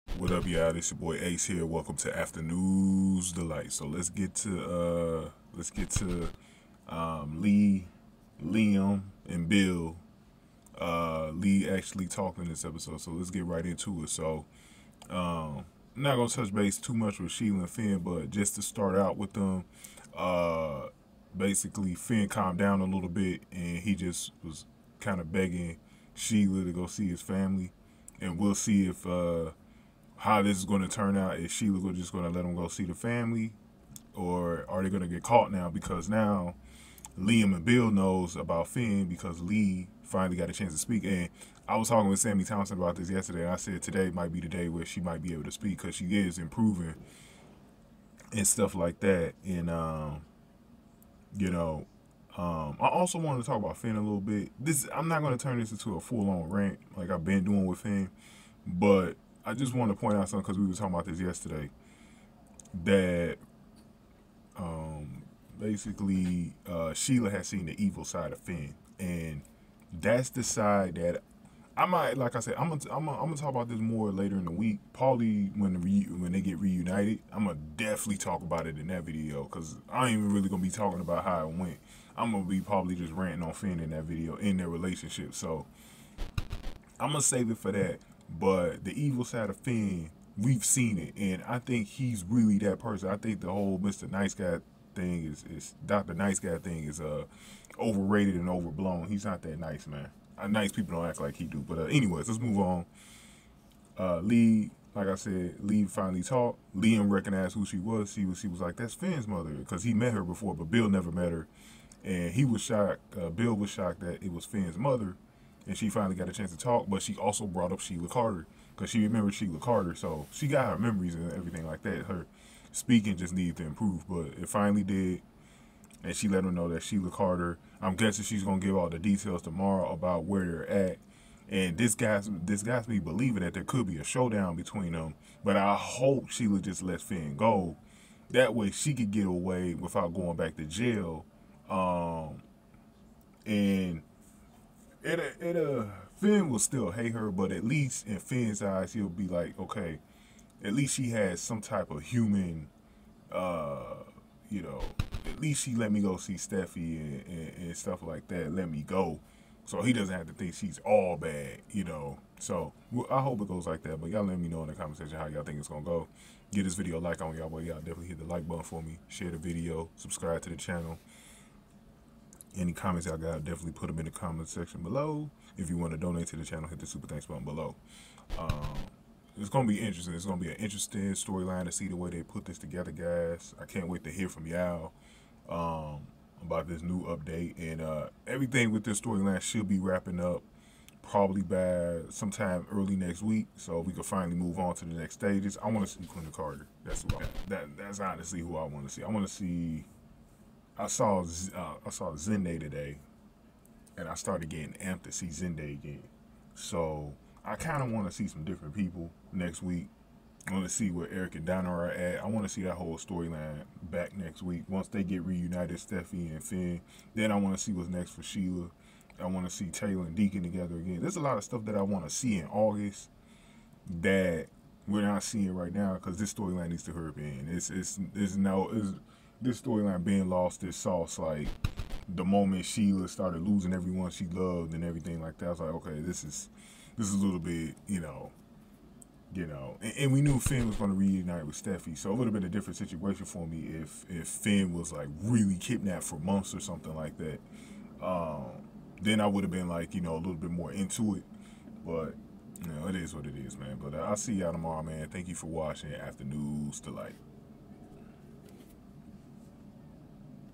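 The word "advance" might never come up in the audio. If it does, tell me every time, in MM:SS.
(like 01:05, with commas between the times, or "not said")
not said.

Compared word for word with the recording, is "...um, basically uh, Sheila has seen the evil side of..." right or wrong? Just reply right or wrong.
right.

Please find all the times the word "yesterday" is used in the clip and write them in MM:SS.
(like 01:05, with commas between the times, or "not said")
00:43, 01:01.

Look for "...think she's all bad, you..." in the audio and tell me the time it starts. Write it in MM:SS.
02:40.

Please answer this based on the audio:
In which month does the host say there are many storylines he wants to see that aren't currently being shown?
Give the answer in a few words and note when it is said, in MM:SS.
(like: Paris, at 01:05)
August, at 03:42.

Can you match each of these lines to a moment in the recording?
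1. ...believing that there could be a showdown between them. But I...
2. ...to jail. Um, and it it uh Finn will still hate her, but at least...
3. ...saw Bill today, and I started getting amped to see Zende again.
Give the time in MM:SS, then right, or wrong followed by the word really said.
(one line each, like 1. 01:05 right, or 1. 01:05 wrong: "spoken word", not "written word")
1. 02:12 right
2. 02:20 right
3. 03:21 wrong: "Zende", not "Bill".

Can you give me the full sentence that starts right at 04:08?
Um, then I would have been like, you know, a little bit more into it, but.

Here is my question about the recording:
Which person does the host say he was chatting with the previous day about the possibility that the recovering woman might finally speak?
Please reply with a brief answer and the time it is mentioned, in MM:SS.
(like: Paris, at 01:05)
Sammy Thompson, at 00:42.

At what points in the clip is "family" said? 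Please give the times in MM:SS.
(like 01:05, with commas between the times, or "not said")
00:27, 00:32.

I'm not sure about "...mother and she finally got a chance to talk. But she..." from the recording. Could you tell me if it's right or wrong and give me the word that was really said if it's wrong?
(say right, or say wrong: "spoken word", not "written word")
right.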